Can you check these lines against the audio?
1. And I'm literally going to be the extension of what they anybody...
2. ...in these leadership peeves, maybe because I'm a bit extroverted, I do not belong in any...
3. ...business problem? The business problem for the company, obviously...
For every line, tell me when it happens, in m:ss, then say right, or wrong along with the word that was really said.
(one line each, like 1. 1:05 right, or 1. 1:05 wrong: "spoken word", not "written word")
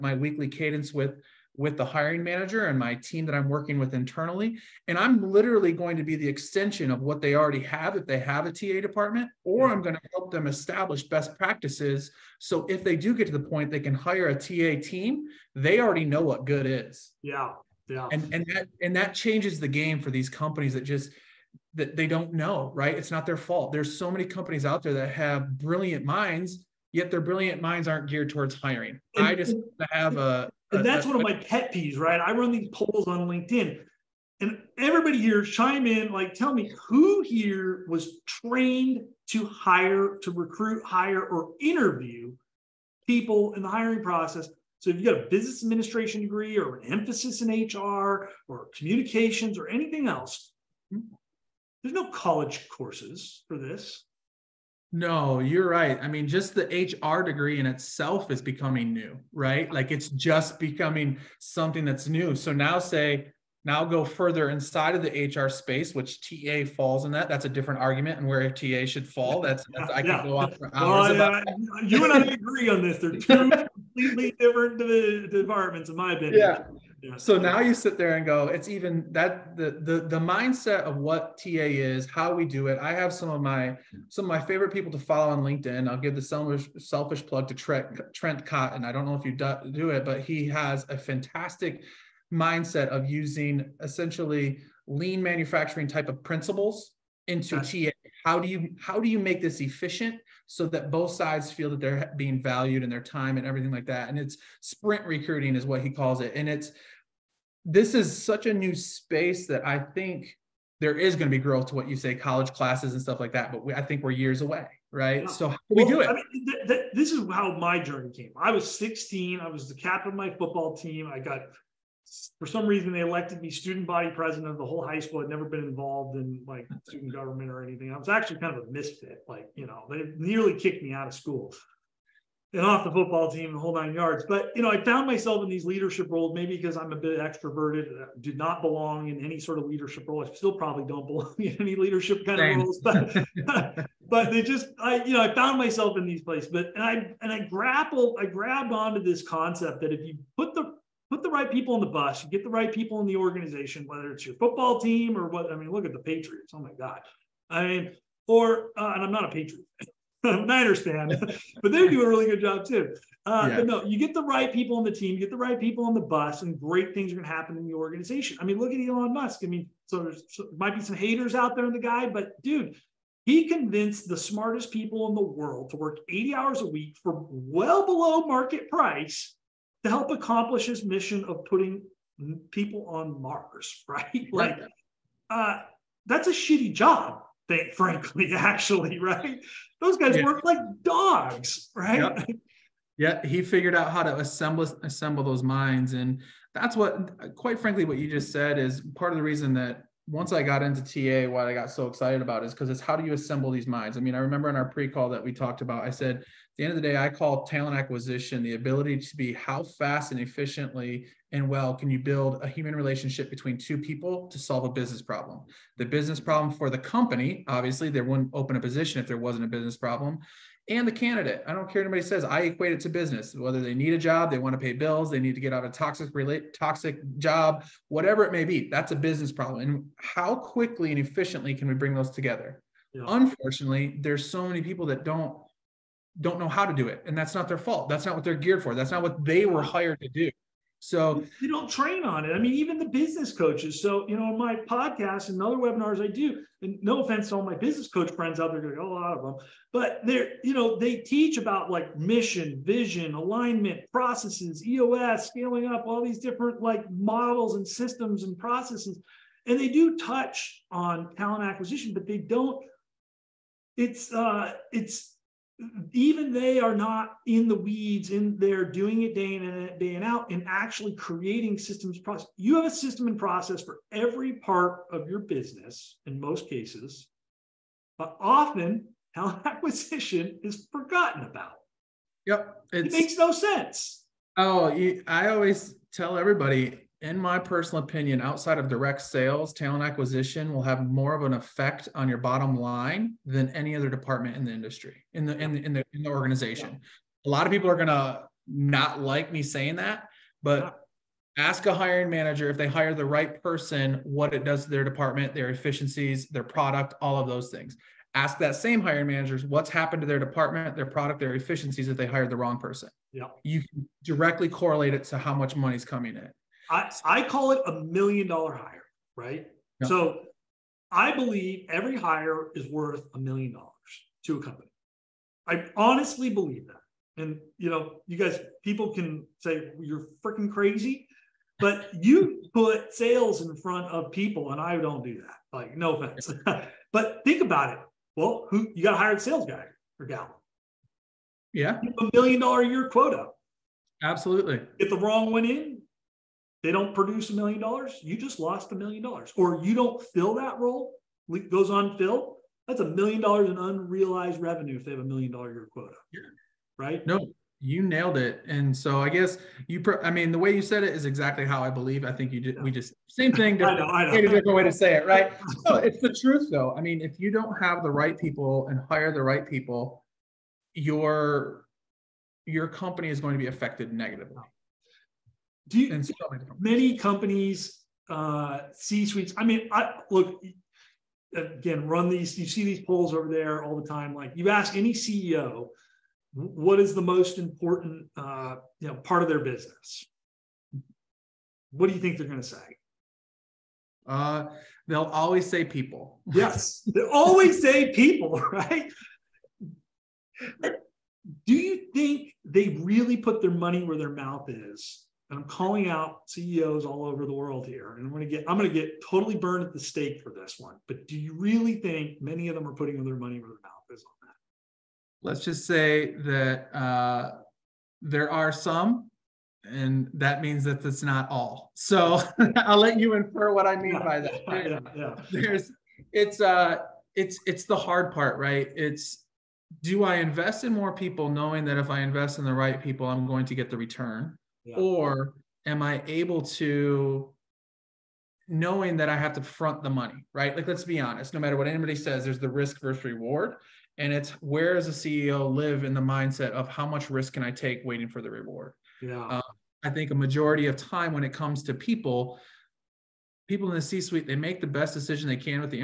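1. 0:04 wrong: "already", not "anybody"
2. 2:15 wrong: "roles", not "peeves"
3. 3:34 right.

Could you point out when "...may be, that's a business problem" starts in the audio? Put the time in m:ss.
3:48.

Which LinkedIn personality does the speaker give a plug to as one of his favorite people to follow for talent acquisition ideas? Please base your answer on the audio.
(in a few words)
Trent Cotton.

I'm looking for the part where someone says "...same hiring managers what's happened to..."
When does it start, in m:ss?
5:08.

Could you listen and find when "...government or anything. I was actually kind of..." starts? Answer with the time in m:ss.
2:07.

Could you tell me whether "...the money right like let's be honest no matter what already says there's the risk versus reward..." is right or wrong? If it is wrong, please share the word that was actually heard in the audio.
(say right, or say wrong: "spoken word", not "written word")
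wrong: "anybody", not "already".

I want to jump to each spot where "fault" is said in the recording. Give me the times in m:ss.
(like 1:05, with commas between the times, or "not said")
0:23, 3:57.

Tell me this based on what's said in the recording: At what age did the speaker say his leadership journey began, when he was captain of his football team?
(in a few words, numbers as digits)
16.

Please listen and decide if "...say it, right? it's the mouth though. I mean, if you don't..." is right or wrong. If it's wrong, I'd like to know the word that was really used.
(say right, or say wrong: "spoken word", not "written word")
wrong: "truth", not "mouth".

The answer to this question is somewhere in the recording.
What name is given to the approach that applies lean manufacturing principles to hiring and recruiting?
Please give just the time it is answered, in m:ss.
1:44.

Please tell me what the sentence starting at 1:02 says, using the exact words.
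So now, say, now go further inside of the HR space, which TA falls in that.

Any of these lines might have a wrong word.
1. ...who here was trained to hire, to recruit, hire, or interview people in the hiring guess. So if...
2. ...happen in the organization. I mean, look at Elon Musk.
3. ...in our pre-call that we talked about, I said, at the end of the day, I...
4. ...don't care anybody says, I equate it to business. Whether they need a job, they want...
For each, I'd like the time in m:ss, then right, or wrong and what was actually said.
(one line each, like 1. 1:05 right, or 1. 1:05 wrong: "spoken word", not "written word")
1. 0:36 wrong: "process", not "guess"
2. 2:47 right
3. 3:24 right
4. 3:41 right.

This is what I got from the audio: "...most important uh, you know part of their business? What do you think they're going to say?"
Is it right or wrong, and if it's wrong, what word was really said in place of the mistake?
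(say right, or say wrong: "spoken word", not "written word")
right.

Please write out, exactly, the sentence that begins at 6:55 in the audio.
Let's just say that uh, there are some, and that means that that's not all.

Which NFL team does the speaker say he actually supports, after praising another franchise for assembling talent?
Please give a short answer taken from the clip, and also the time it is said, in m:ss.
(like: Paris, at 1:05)
Niners, at 2:40.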